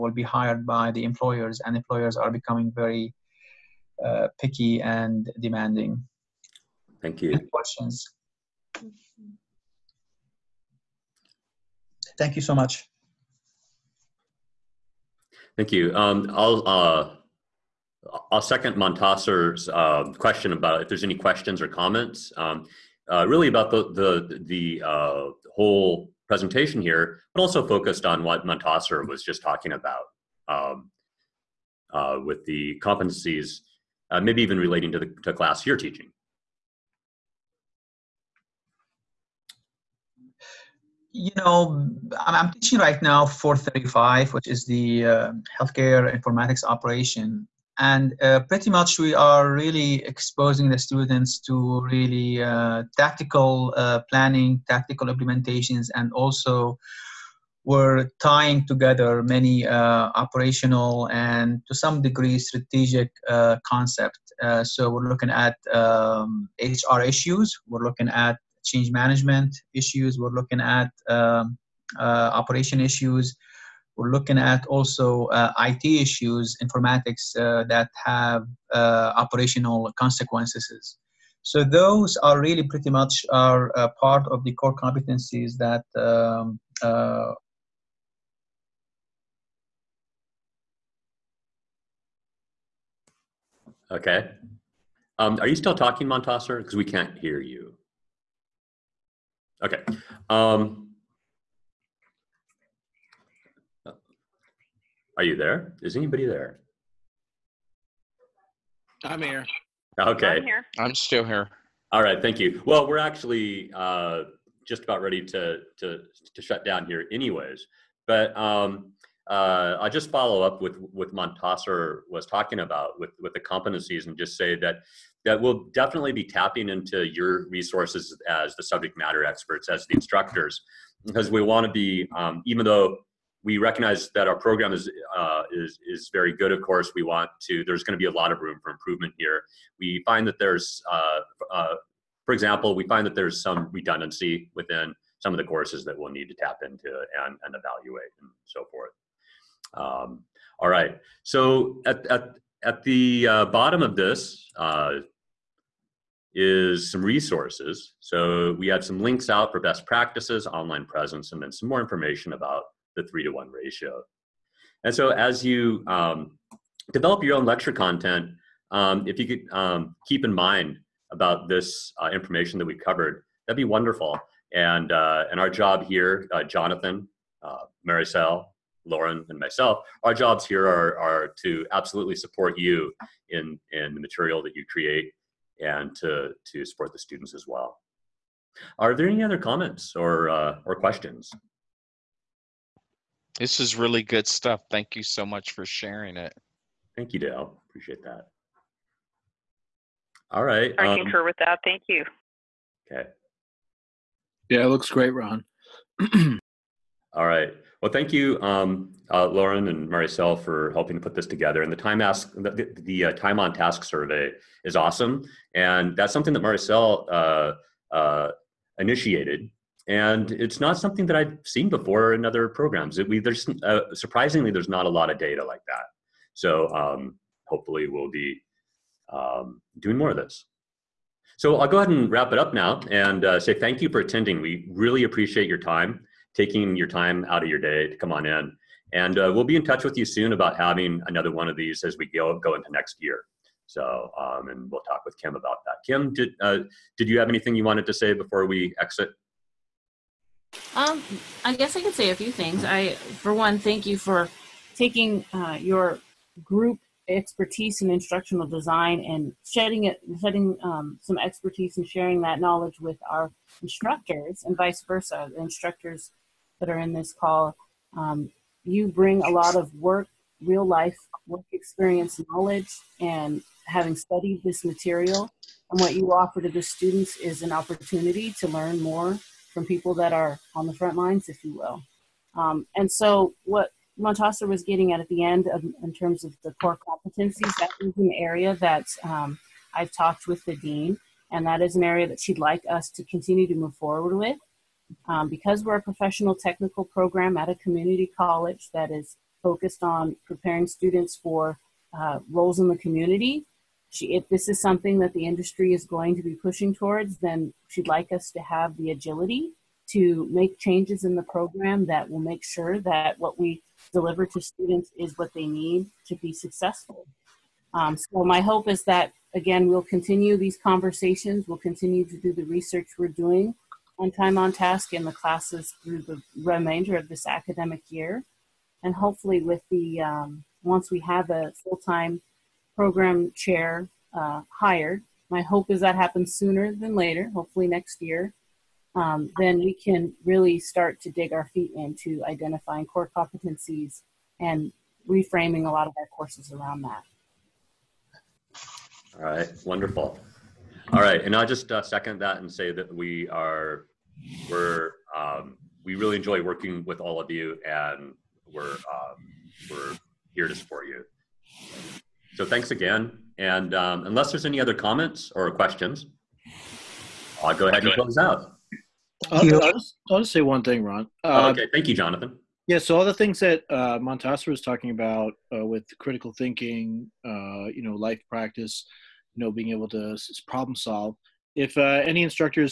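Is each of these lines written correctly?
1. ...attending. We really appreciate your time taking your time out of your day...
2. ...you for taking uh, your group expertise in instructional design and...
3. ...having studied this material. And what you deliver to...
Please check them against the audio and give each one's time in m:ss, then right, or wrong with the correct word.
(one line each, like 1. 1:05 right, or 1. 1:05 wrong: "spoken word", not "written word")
1. 3:53 right
2. 4:13 right
3. 4:33 wrong: "offer", not "deliver".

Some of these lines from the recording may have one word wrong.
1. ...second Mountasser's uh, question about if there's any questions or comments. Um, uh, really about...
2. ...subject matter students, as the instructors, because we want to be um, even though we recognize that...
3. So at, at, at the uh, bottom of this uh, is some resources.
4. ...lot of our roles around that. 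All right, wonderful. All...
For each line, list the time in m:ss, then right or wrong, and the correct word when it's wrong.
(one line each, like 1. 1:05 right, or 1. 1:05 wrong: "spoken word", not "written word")
1. 0:18 right
2. 2:08 wrong: "experts", not "students"
3. 2:31 right
4. 5:45 wrong: "courses", not "roles".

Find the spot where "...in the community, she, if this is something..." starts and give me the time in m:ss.
5:02.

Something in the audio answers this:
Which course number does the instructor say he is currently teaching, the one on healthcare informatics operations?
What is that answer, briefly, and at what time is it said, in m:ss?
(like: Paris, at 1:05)
435, at 0:43.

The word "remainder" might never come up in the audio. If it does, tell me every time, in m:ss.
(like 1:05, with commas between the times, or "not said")
5:26.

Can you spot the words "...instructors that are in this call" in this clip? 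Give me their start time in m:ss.
4:25.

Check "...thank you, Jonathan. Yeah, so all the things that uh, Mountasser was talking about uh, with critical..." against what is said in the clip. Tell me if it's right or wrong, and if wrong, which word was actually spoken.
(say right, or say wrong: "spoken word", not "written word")
right.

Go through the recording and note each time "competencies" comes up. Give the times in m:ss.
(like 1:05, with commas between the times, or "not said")
0:32, 1:24, 2:03, 4:46, 5:43.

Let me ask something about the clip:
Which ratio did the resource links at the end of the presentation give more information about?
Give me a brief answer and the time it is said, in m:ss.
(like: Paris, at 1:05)
3 to 1, at 2:43.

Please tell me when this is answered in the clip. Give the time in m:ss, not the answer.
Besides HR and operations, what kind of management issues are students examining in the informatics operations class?
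1:08.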